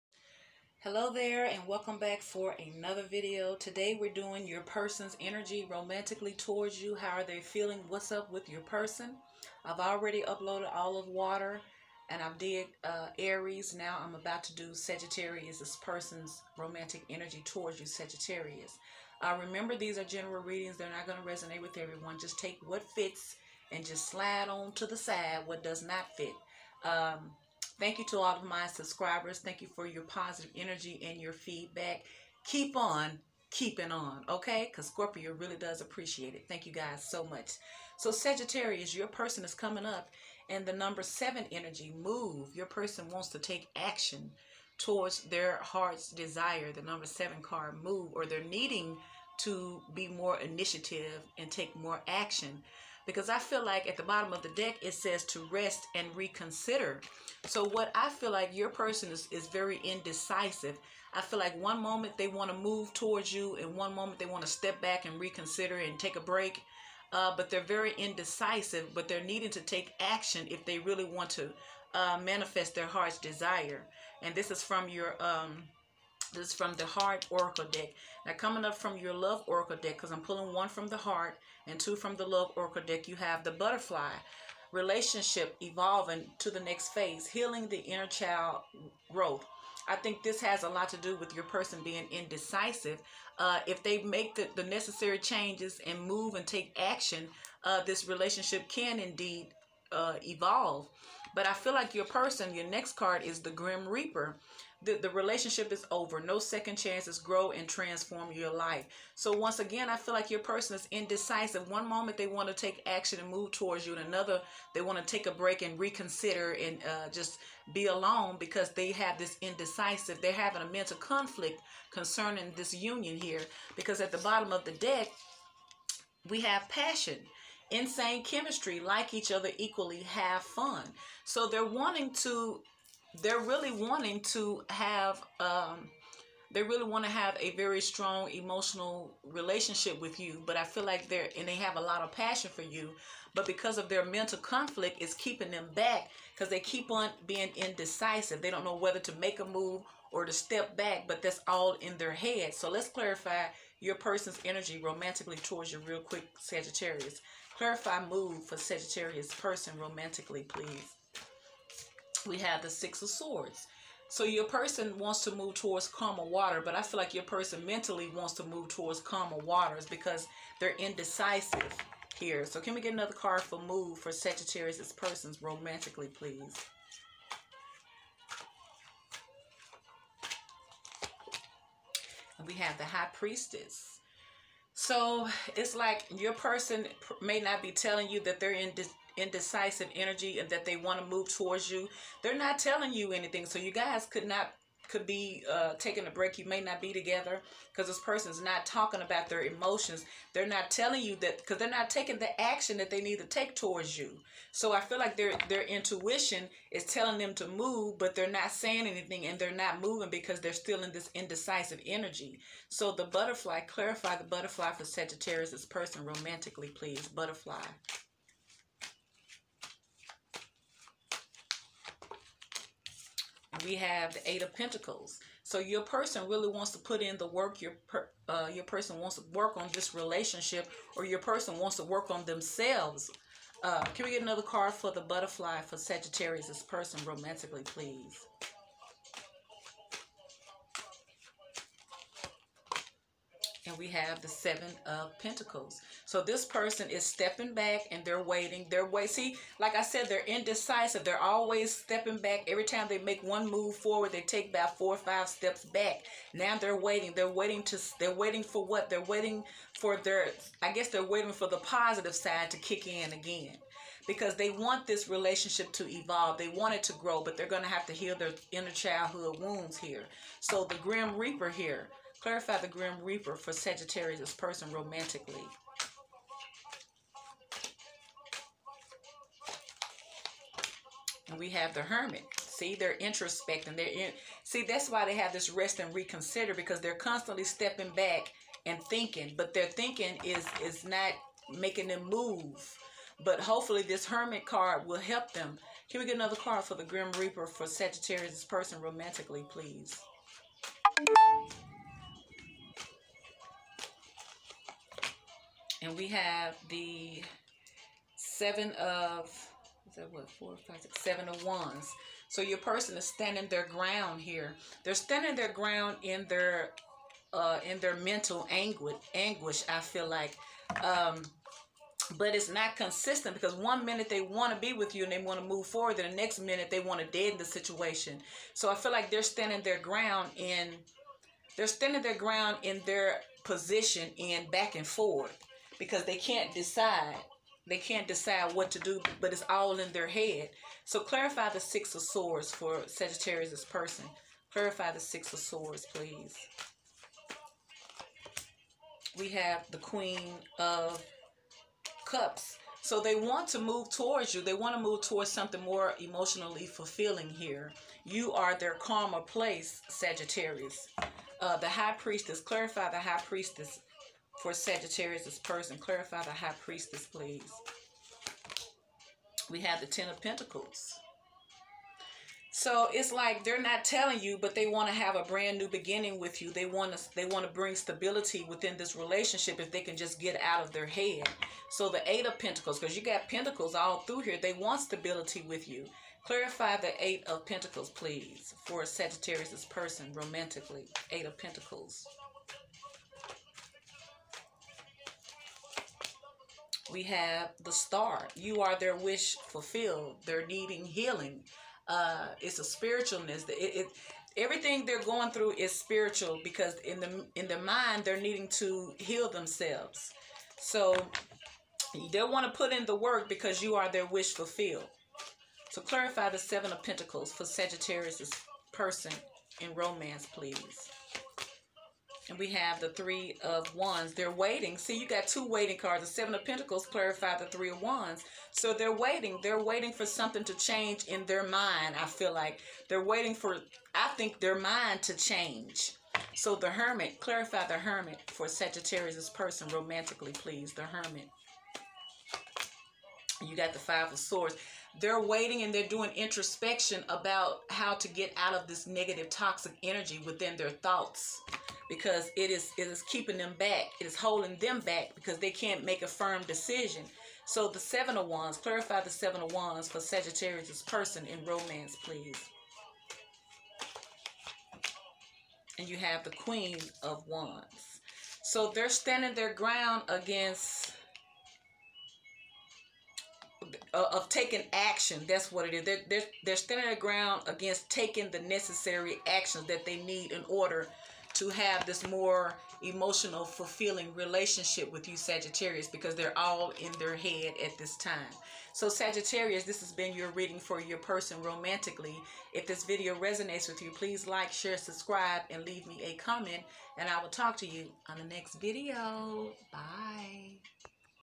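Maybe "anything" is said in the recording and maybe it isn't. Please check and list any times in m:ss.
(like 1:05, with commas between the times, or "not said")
3:13, 3:28.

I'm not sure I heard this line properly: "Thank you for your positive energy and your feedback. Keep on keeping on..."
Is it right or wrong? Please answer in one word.
right.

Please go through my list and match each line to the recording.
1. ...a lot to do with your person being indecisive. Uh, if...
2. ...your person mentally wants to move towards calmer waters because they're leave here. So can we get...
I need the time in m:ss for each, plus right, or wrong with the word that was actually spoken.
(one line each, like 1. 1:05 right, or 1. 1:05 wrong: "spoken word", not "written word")
1. 1:30 right
2. 2:47 wrong: "indecisive", not "leave".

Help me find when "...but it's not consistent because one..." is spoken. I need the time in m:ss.
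5:22.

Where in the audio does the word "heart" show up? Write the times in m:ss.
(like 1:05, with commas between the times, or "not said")
0:45, 1:12, 1:16, 1:20.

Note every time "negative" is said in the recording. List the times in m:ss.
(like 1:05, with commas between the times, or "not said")
7:28.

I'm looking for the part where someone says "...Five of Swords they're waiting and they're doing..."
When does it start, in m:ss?
7:23.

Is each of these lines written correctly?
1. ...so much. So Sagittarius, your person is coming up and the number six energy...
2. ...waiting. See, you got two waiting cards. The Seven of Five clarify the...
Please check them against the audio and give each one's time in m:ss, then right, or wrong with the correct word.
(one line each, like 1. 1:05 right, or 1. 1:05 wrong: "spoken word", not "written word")
1. 0:37 wrong: "seven", not "six"
2. 7:04 wrong: "Pentacles", not "Five".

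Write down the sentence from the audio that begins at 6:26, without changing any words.
Clarify the Eight of Pentacles, please, for Sagittarius' person romantically.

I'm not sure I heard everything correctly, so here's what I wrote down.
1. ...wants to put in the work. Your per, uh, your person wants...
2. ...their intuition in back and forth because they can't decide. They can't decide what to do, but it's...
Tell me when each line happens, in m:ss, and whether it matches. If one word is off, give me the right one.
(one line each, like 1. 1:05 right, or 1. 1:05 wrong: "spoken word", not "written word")
1. 3:46 right
2. 5:32 wrong: "position", not "intuition".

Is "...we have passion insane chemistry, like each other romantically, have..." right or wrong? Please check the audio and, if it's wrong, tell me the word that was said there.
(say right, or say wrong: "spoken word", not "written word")
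wrong: "equally", not "romantically".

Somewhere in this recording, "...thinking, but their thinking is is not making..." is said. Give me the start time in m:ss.
4:48.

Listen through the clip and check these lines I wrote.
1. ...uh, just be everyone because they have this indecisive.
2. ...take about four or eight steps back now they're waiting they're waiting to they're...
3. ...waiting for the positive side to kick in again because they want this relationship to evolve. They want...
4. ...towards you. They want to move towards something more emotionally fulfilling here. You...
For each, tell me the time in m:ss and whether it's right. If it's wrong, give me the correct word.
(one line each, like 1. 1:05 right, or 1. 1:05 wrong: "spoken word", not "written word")
1. 1:56 wrong: "alone", not "everyone"
2. 4:14 wrong: "five", not "eight"
3. 4:21 right
4. 5:53 right.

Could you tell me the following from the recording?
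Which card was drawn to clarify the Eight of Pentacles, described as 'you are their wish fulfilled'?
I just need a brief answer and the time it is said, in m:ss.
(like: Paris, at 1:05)
The Star, at 6:37.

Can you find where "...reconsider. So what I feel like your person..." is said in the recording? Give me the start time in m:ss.
0:56.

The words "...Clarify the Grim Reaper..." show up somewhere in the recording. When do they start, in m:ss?
4:32.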